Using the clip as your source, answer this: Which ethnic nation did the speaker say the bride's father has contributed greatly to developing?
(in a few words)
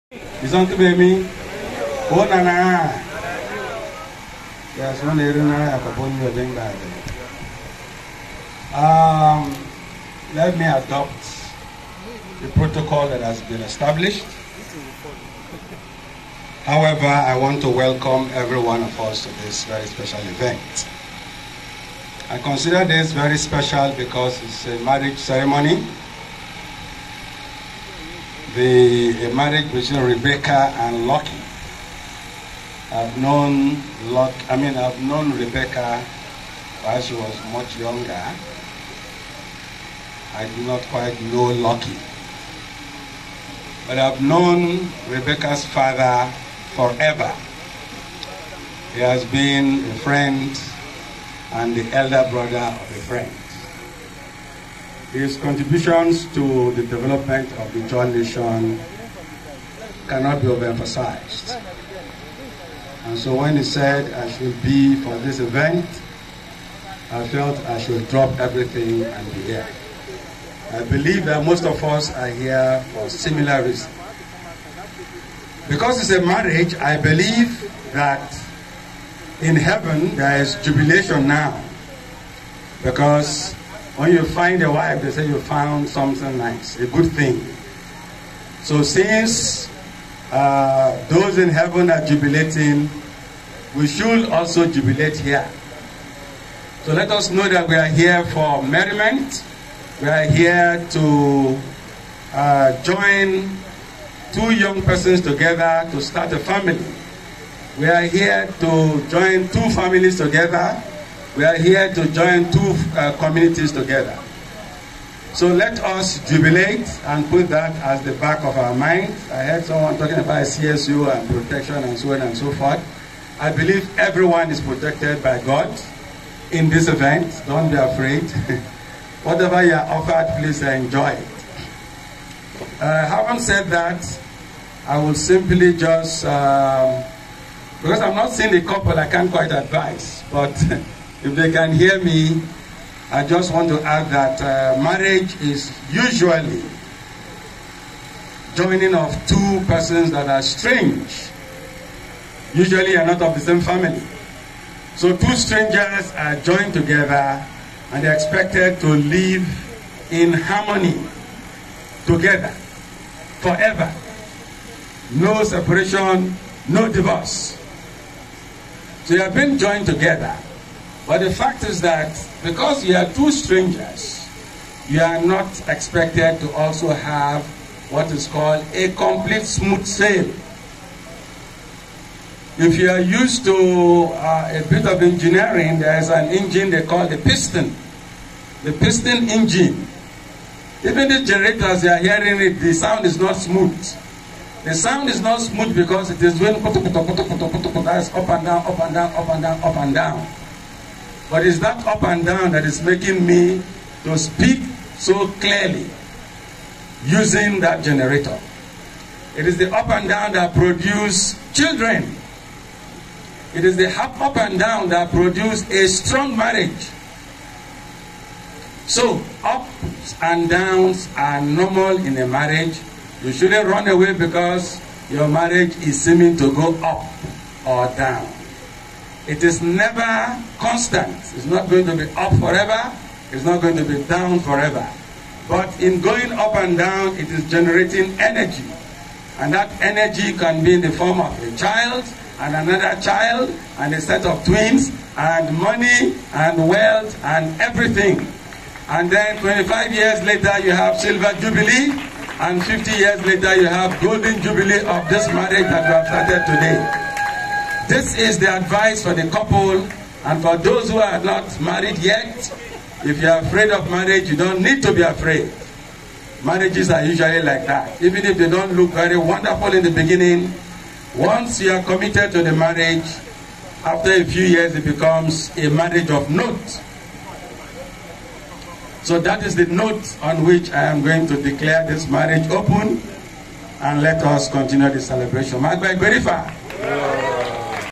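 Ijaw.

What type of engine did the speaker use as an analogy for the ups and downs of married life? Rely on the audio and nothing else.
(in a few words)
piston engine.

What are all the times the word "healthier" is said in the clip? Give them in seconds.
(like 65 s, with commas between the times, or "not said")
not said.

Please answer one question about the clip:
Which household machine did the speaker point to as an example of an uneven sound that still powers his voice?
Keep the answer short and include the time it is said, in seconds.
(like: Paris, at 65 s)
generator, at 207 s.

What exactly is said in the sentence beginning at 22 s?
I consider this very special because it's a marriage ceremony the marriage between Rebecca and Lucky.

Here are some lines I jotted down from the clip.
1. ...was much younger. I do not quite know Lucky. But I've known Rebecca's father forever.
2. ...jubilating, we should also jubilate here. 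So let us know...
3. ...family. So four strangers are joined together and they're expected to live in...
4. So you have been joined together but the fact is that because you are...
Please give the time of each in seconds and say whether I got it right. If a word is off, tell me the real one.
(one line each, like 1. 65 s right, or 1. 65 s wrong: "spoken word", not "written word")
1. 37 s right
2. 92 s right
3. 153 s wrong: "two", not "four"
4. 169 s right.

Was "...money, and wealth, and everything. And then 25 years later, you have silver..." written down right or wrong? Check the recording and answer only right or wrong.
right.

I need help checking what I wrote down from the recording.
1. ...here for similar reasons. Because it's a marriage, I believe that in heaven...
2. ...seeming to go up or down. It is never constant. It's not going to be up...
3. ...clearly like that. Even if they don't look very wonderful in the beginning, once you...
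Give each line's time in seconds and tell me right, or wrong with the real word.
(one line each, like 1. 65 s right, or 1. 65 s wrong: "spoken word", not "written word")
1. 72 s right
2. 226 s right
3. 267 s wrong: "usually", not "clearly".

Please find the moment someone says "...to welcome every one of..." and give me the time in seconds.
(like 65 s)
17 s.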